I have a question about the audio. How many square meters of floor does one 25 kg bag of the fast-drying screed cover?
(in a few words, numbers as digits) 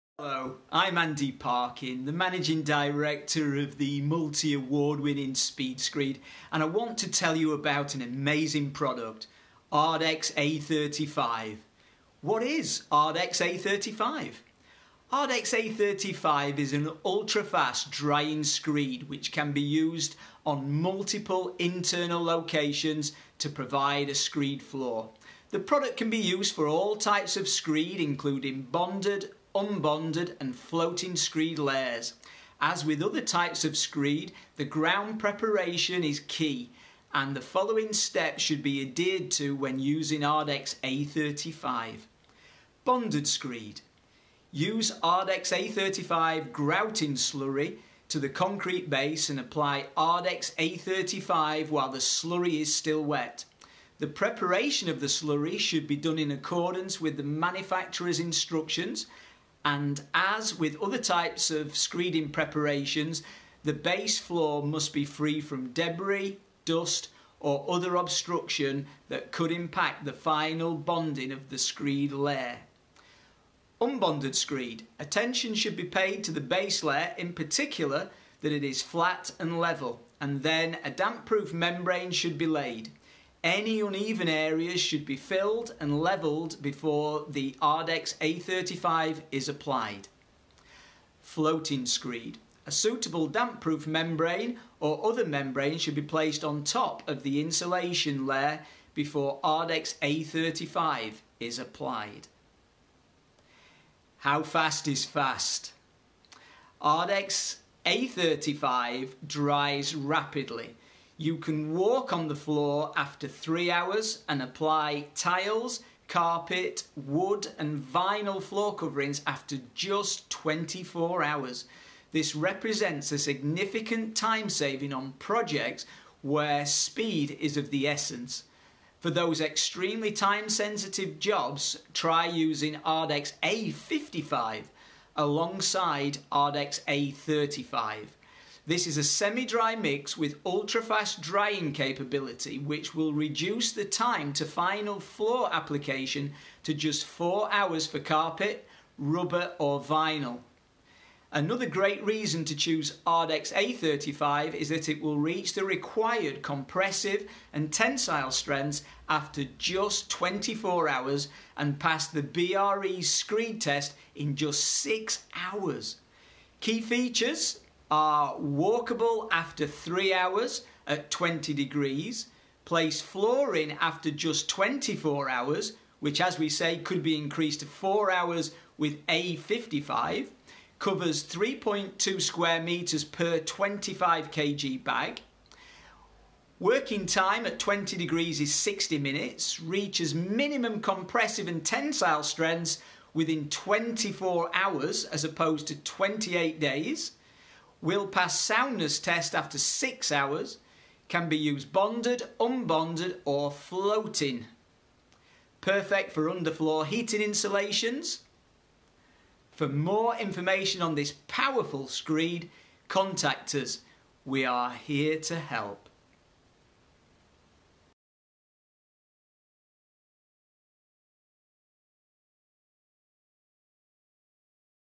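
3.2 square meters.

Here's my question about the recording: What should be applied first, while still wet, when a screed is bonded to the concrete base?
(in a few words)
Ardex A35 grouting slurry.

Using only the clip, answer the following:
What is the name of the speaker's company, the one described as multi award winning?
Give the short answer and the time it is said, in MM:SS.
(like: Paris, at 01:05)
Speed Screed, at 00:05.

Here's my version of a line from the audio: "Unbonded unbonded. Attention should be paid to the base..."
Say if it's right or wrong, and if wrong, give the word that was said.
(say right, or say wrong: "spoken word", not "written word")
wrong: "screed", not "unbonded".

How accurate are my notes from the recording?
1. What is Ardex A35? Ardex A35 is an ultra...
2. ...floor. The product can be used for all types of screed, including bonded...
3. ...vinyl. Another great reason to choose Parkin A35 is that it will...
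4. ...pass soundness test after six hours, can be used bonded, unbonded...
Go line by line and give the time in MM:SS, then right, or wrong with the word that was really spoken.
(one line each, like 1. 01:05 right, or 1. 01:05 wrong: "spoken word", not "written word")
1. 00:12 right
2. 00:24 right
3. 02:29 wrong: "Ardex", not "Parkin"
4. 03:18 right.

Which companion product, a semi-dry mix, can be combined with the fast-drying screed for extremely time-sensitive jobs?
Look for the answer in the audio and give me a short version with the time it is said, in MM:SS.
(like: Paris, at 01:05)
Ardex A55, at 02:12.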